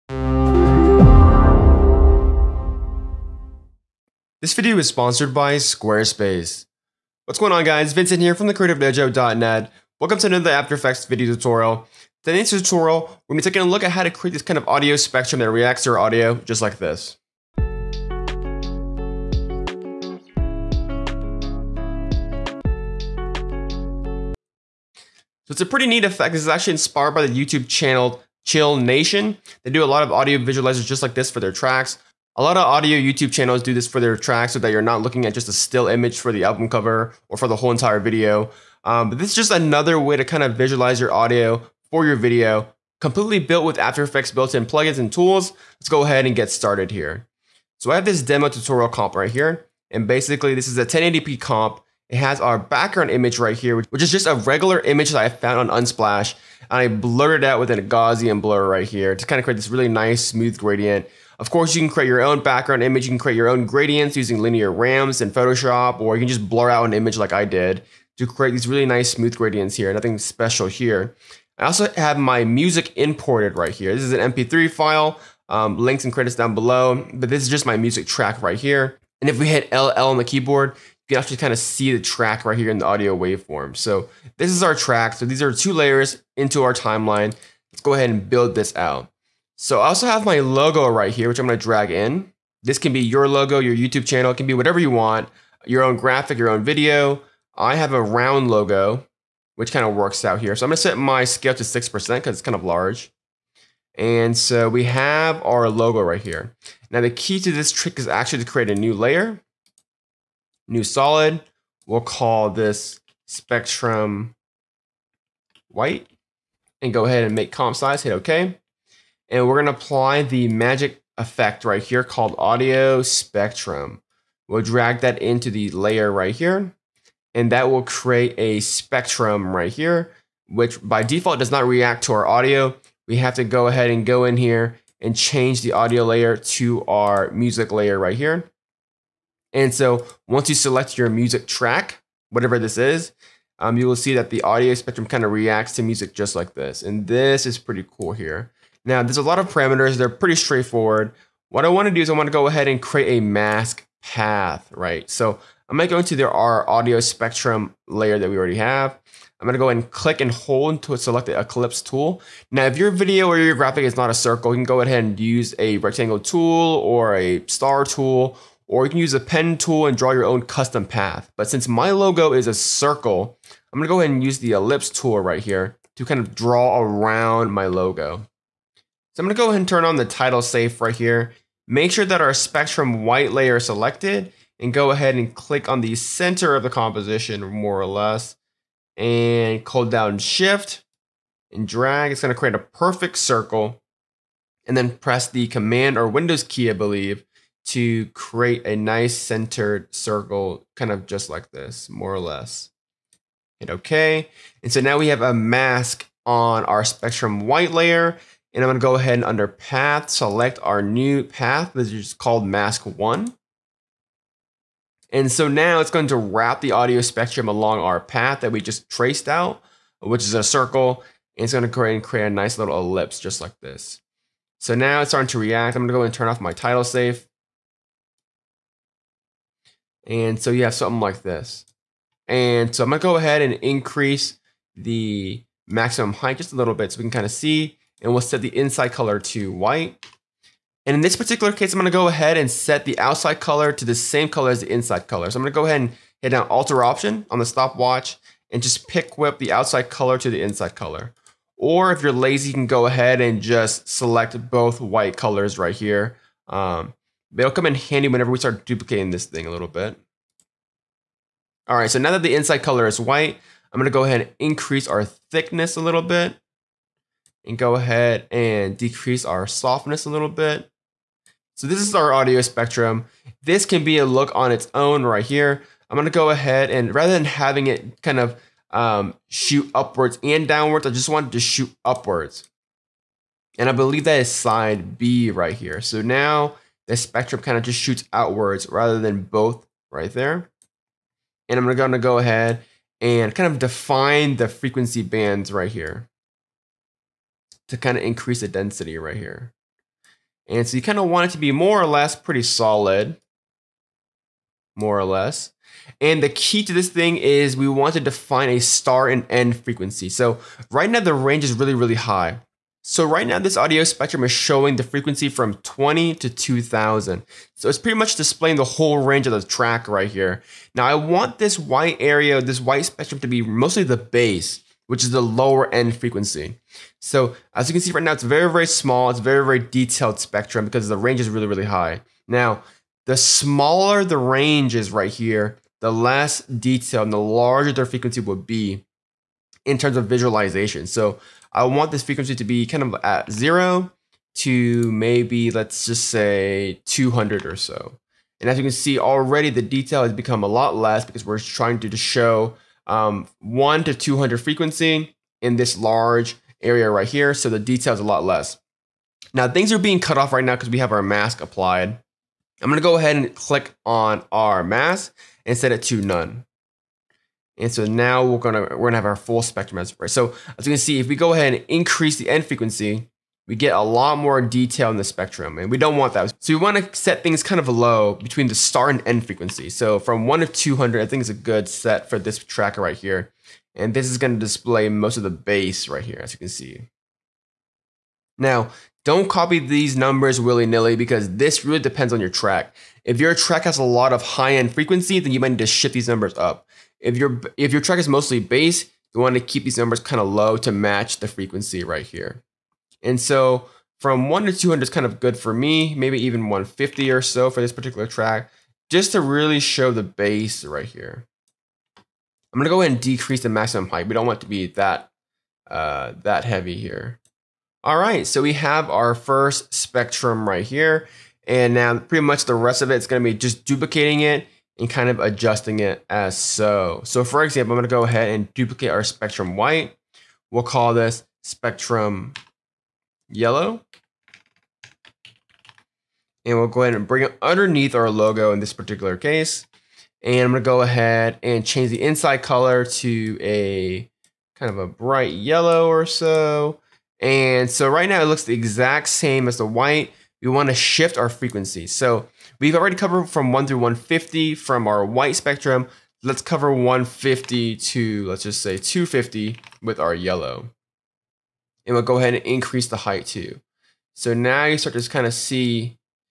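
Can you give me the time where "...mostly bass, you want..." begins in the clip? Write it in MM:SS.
06:38.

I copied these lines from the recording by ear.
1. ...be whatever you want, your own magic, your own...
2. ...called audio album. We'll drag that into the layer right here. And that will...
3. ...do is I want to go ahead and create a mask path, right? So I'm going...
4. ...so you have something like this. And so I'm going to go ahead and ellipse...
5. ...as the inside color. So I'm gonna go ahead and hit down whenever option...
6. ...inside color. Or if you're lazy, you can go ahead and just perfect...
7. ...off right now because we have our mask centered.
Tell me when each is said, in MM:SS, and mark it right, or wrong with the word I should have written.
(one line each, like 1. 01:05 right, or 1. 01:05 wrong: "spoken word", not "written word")
1. 01:34 wrong: "graphic", not "magic"
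2. 02:02 wrong: "spectrum", not "album"
3. 02:31 right
4. 03:50 wrong: "increase", not "ellipse"
5. 04:04 wrong: "alter", not "whenever"
6. 04:10 wrong: "select", not "perfect"
7. 06:00 wrong: "applied", not "centered".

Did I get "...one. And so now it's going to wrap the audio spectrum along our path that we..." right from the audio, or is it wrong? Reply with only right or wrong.
right.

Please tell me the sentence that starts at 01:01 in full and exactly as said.
Of course, you can create your own background image.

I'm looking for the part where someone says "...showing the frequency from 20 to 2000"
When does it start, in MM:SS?
05:14.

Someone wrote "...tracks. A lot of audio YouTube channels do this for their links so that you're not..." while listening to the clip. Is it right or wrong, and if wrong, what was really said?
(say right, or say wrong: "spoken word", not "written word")
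wrong: "tracks", not "links".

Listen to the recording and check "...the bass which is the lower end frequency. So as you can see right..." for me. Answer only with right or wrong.
right.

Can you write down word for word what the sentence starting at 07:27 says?
And so right now it looks the exact same as the white.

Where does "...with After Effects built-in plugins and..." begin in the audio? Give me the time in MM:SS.
00:43.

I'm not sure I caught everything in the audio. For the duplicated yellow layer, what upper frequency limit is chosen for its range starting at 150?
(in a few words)
250.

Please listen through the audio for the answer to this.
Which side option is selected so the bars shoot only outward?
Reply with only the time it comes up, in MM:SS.
04:44.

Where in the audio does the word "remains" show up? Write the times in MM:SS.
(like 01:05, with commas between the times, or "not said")
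not said.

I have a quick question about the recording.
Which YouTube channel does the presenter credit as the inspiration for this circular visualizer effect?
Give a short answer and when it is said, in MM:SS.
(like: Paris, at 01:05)
Chill Nation, at 00:28.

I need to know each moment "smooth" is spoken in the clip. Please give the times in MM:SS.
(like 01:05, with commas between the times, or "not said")
01:00, 01:09.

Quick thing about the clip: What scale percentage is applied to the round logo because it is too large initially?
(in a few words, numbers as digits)
6%.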